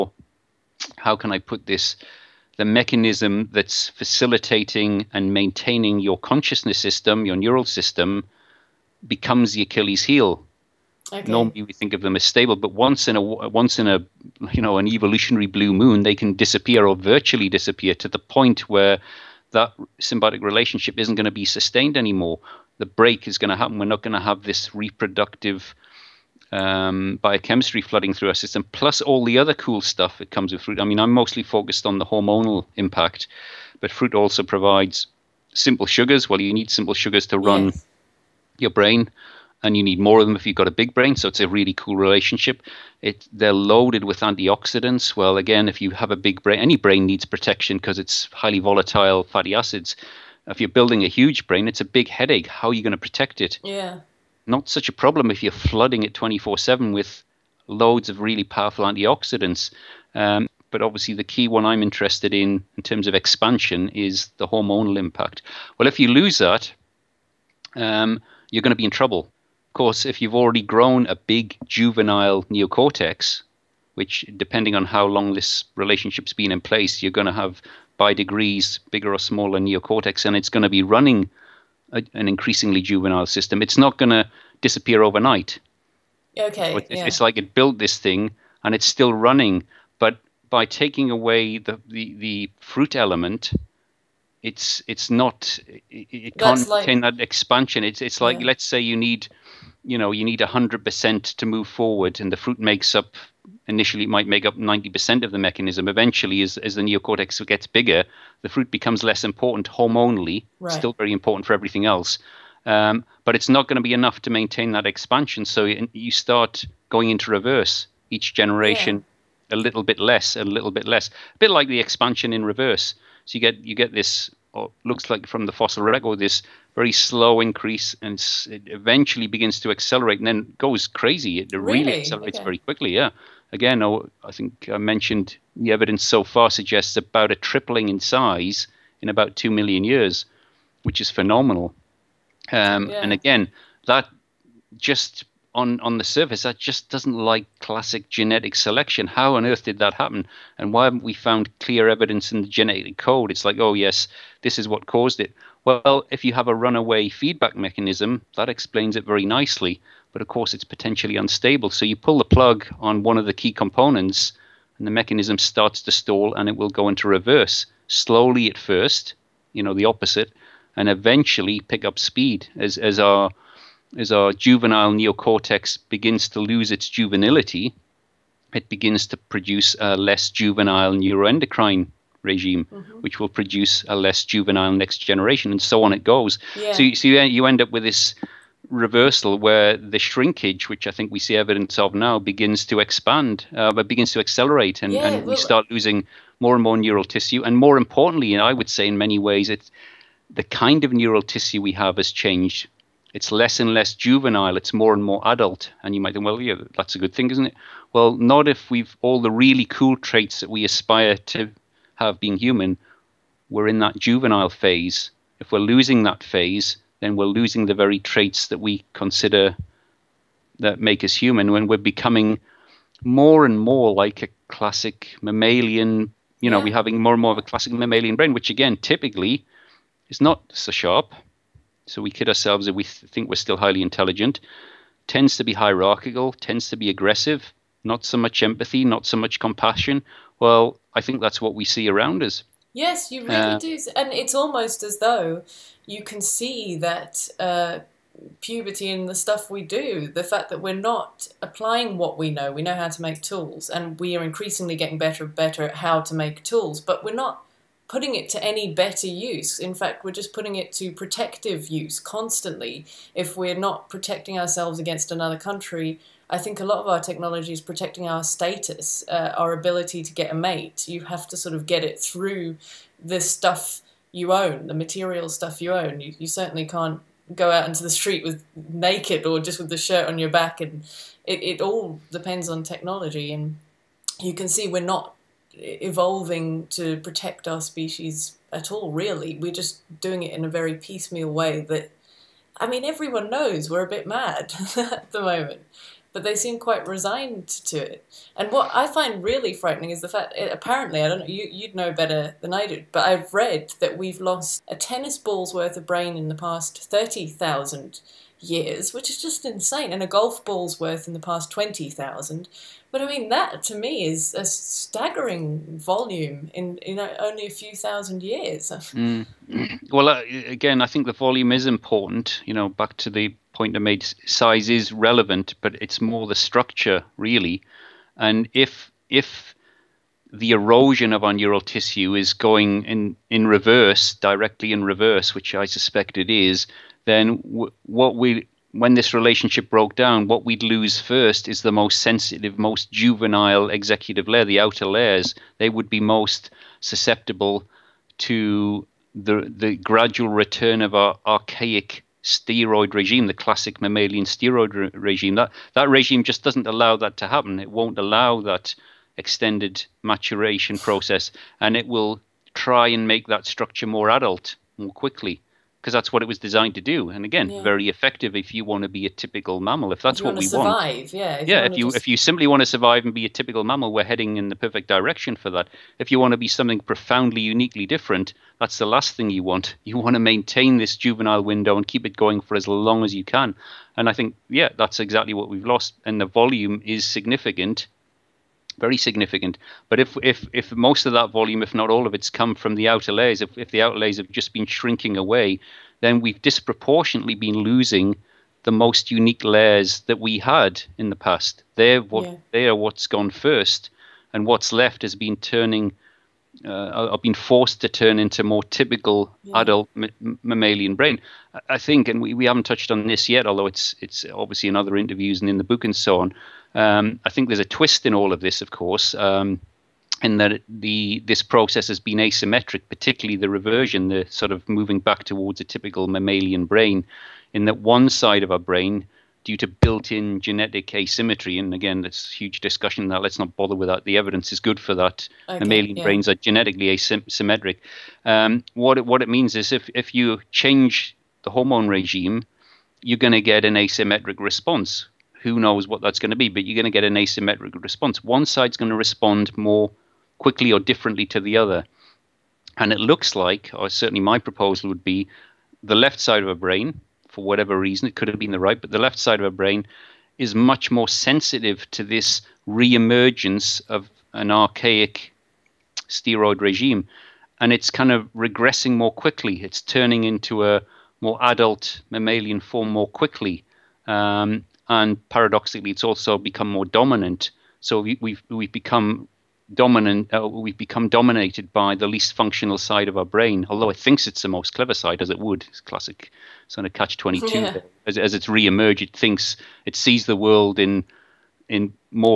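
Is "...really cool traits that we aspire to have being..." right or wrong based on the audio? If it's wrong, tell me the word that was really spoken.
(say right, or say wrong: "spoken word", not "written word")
right.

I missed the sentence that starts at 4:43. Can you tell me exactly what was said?
And you can see we're not evolving to protect our species at all, really.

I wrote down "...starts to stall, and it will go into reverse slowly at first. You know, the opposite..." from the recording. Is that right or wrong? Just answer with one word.
right.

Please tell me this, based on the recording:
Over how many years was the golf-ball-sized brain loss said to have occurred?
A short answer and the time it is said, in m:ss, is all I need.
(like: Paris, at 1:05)
20,000, at 5:11.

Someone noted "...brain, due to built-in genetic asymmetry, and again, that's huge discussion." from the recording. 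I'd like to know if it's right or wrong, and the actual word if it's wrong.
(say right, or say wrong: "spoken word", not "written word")
right.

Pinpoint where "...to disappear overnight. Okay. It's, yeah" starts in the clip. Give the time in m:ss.
1:24.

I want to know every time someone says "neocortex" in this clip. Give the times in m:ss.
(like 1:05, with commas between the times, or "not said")
1:12, 1:19, 1:46, 2:54.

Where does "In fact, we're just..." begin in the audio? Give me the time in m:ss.
4:19.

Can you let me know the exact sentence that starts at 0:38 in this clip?
your brain, and you need more of them if you've got a big brain.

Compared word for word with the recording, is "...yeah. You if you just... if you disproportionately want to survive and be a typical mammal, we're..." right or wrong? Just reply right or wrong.
wrong.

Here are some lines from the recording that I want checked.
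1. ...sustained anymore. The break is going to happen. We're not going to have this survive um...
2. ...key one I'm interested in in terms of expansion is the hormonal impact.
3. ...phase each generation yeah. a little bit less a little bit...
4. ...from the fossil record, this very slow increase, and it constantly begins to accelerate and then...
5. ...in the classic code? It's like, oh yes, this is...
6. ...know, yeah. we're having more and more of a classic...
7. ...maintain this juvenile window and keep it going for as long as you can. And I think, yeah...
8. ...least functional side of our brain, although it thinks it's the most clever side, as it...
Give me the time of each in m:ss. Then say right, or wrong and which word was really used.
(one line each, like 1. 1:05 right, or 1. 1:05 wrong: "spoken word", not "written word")
1. 0:21 wrong: "reproductive", not "survive"
2. 1:01 right
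3. 1:57 wrong: "reverse", not "phase"
4. 2:05 wrong: "eventually", not "constantly"
5. 2:32 wrong: "genetic", not "classic"
6. 3:46 right
7. 6:20 right
8. 8:02 right.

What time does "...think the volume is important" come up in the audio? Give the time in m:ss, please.
5:20.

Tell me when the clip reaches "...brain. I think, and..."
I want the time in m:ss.
6:50.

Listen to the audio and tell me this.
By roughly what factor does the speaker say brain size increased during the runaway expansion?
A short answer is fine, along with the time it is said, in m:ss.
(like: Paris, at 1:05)
tripling, at 2:17.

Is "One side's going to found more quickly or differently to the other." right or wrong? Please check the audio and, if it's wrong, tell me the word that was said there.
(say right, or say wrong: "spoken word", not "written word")
wrong: "respond", not "found".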